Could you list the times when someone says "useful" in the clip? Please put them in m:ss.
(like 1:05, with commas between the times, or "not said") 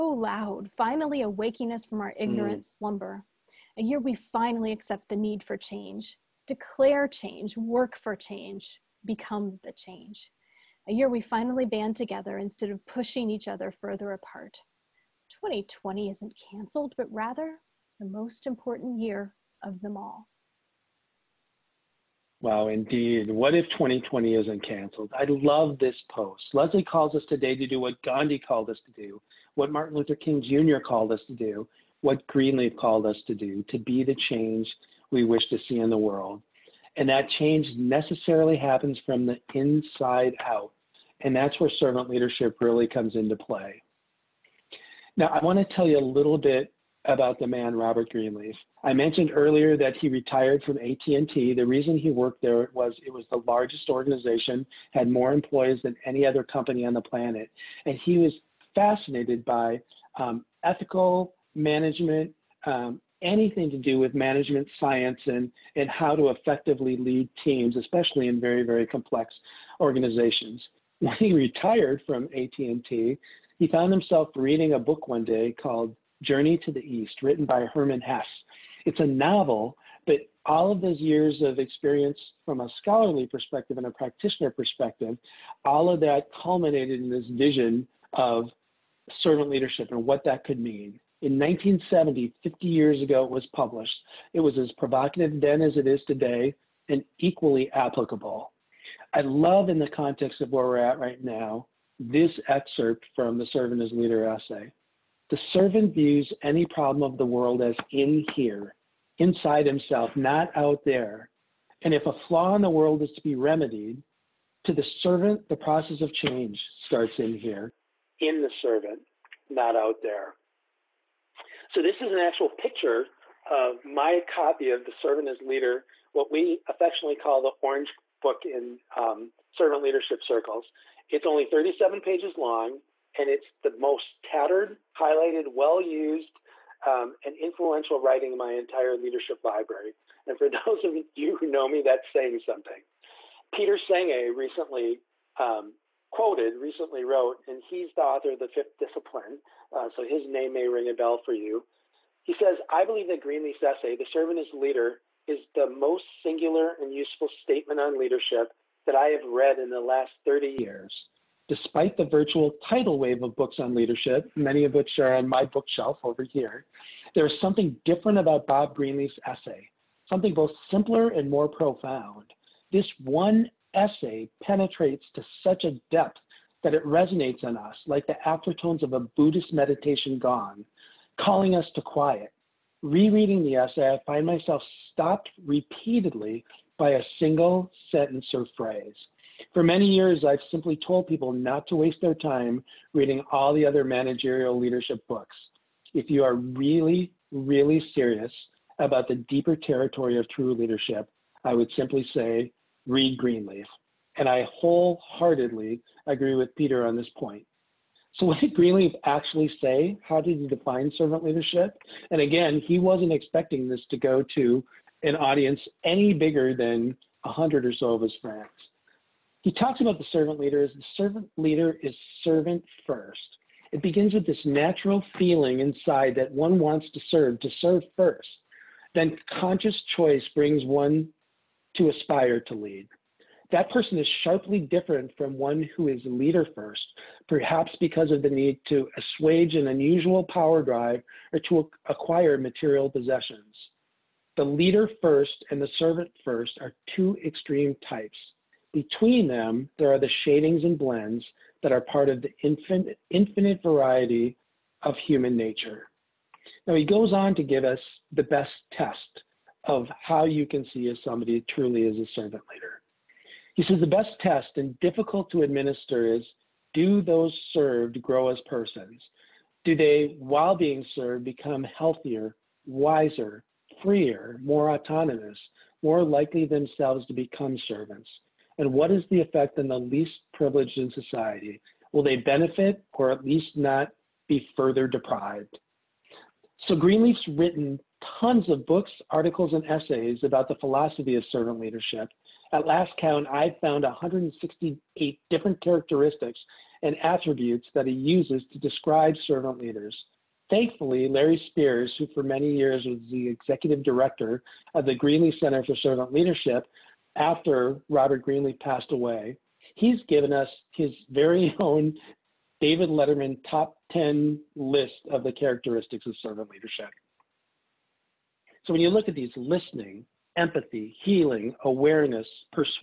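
2:36.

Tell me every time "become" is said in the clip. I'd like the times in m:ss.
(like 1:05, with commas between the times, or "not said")
0:09, 4:31, 4:37.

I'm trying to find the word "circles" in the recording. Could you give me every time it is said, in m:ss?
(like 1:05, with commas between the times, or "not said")
2:10.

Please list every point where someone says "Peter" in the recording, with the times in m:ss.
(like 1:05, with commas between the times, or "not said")
2:23, 3:26.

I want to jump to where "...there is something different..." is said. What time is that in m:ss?
2:47.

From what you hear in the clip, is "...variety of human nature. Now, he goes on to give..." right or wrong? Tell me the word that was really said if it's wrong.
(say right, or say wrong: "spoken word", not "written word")
right.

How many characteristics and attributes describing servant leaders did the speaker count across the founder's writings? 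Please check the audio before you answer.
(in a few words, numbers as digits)
168.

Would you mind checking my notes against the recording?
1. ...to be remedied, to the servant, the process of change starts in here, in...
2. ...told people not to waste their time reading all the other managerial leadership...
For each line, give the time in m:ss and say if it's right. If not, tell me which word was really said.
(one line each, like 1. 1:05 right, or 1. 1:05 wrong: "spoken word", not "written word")
1. 1:53 right
2. 3:10 right.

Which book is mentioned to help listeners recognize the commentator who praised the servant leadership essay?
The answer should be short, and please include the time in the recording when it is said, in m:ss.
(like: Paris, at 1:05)
The Fifth Discipline, at 2:28.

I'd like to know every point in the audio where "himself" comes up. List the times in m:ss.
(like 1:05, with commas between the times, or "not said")
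1:13, 1:49.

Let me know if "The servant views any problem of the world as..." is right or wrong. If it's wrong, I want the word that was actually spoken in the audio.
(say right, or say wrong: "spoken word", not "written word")
right.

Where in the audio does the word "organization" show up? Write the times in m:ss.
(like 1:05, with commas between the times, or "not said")
0:53, 1:09.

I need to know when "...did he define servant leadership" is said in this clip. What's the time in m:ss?
3:30.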